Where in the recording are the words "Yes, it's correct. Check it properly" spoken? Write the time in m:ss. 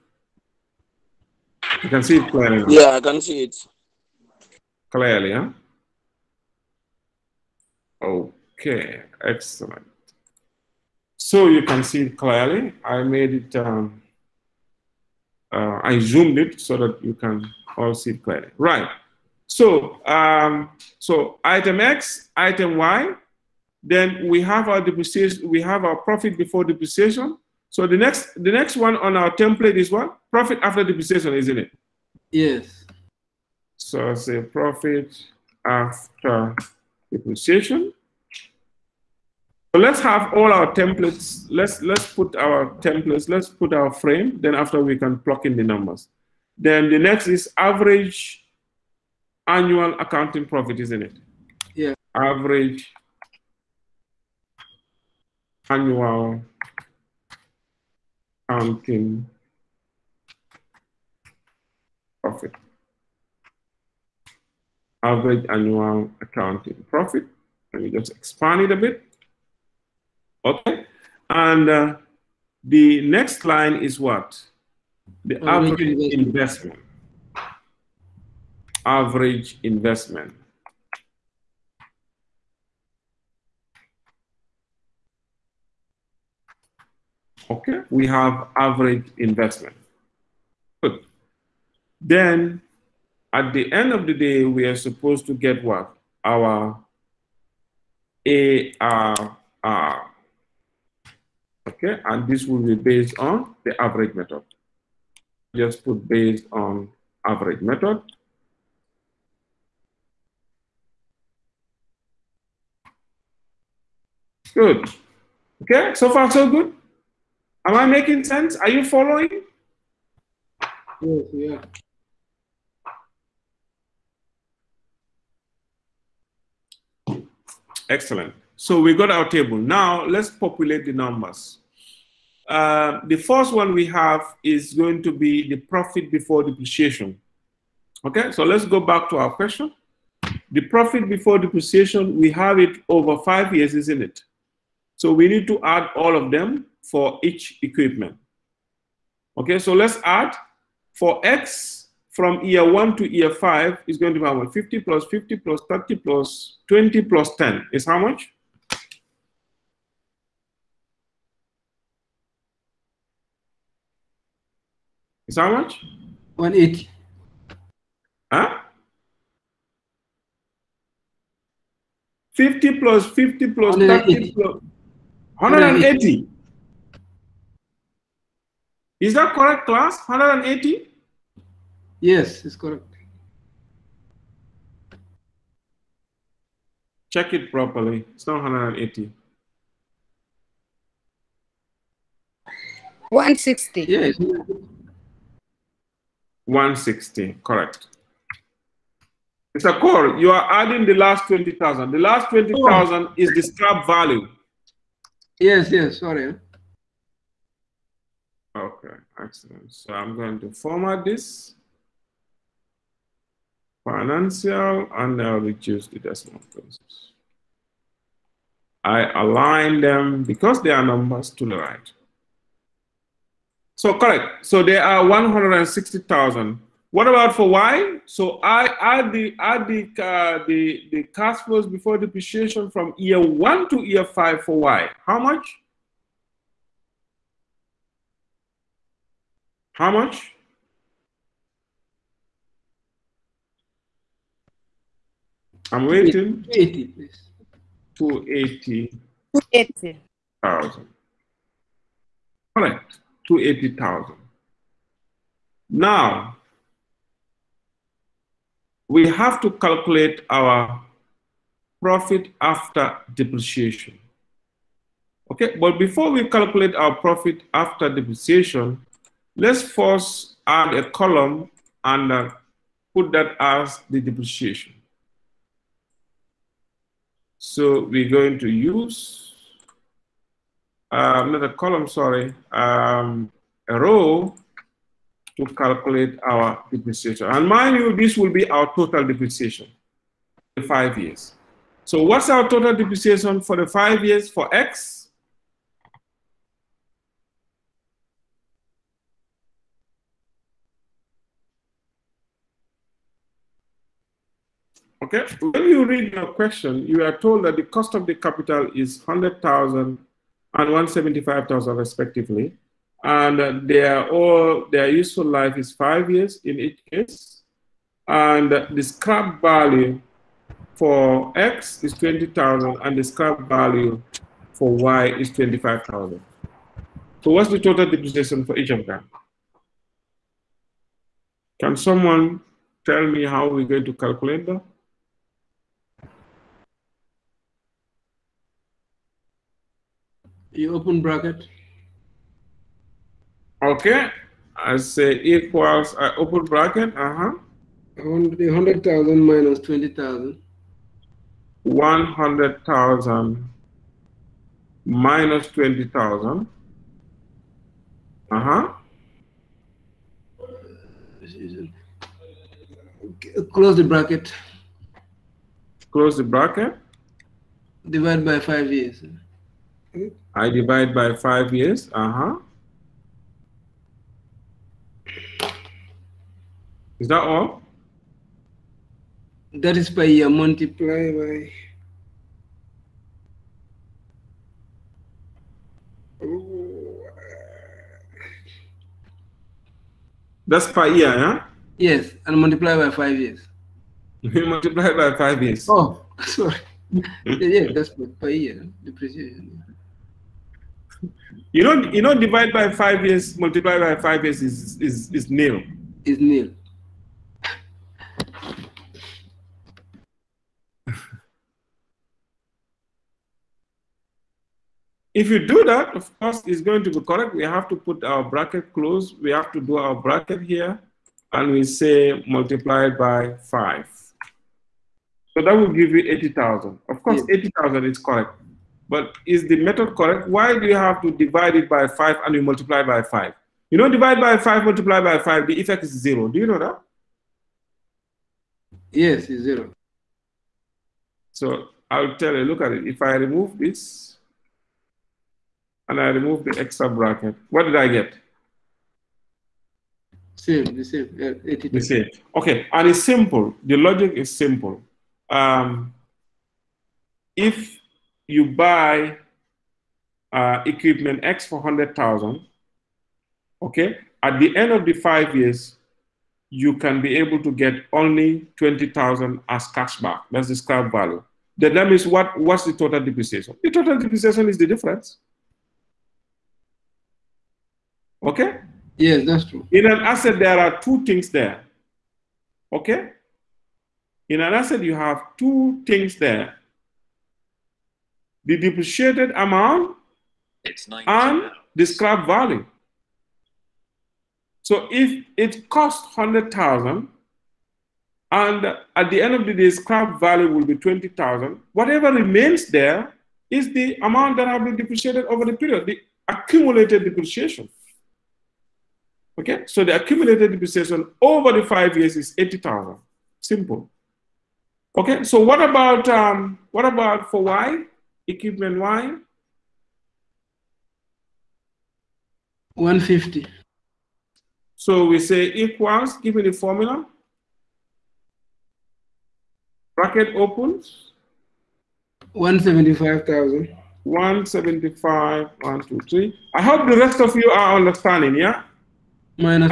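3:02.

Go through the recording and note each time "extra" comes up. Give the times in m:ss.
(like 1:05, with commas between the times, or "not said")
7:26.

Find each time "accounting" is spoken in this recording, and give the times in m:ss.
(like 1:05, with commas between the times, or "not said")
0:49, 0:58, 1:06.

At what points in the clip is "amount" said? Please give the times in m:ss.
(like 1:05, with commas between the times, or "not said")
8:09, 8:24.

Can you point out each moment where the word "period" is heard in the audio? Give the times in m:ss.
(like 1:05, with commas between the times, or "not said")
8:25.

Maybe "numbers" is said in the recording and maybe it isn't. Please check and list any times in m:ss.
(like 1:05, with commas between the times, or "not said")
0:45, 2:10, 3:40.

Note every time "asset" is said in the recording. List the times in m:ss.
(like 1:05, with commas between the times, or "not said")
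8:00, 8:04.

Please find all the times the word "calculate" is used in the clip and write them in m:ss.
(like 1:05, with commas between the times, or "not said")
4:19, 4:26, 4:45, 5:33.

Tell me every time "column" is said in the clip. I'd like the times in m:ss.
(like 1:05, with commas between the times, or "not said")
4:30, 4:41.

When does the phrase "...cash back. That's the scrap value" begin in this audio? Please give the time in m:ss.
7:49.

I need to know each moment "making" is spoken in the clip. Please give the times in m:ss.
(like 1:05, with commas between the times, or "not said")
1:57.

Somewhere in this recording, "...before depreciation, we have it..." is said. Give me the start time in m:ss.
2:21.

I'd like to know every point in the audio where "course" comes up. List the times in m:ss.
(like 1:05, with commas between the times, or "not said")
6:56, 7:07.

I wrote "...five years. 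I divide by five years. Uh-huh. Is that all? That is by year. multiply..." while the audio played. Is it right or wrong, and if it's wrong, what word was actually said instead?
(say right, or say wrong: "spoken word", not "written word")
right.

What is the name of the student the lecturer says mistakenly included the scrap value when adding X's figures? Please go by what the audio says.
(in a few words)
Mr. Cole.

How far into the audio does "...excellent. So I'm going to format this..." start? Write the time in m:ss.
3:29.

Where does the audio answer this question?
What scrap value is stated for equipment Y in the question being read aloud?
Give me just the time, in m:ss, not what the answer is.
5:25.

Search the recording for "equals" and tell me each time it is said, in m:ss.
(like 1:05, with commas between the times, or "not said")
5:45, 8:45.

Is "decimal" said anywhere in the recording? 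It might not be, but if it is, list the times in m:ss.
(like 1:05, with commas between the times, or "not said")
3:35.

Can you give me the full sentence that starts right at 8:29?
Okay, so the accumulated depreciation over the five years is 80,000, simple.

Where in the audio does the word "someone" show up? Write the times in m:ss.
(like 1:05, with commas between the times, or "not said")
5:31.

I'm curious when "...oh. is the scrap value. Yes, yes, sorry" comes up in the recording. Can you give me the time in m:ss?
3:22.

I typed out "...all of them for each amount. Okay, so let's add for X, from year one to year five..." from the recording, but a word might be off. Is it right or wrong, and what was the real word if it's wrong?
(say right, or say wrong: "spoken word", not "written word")
wrong: "equipment", not "amount".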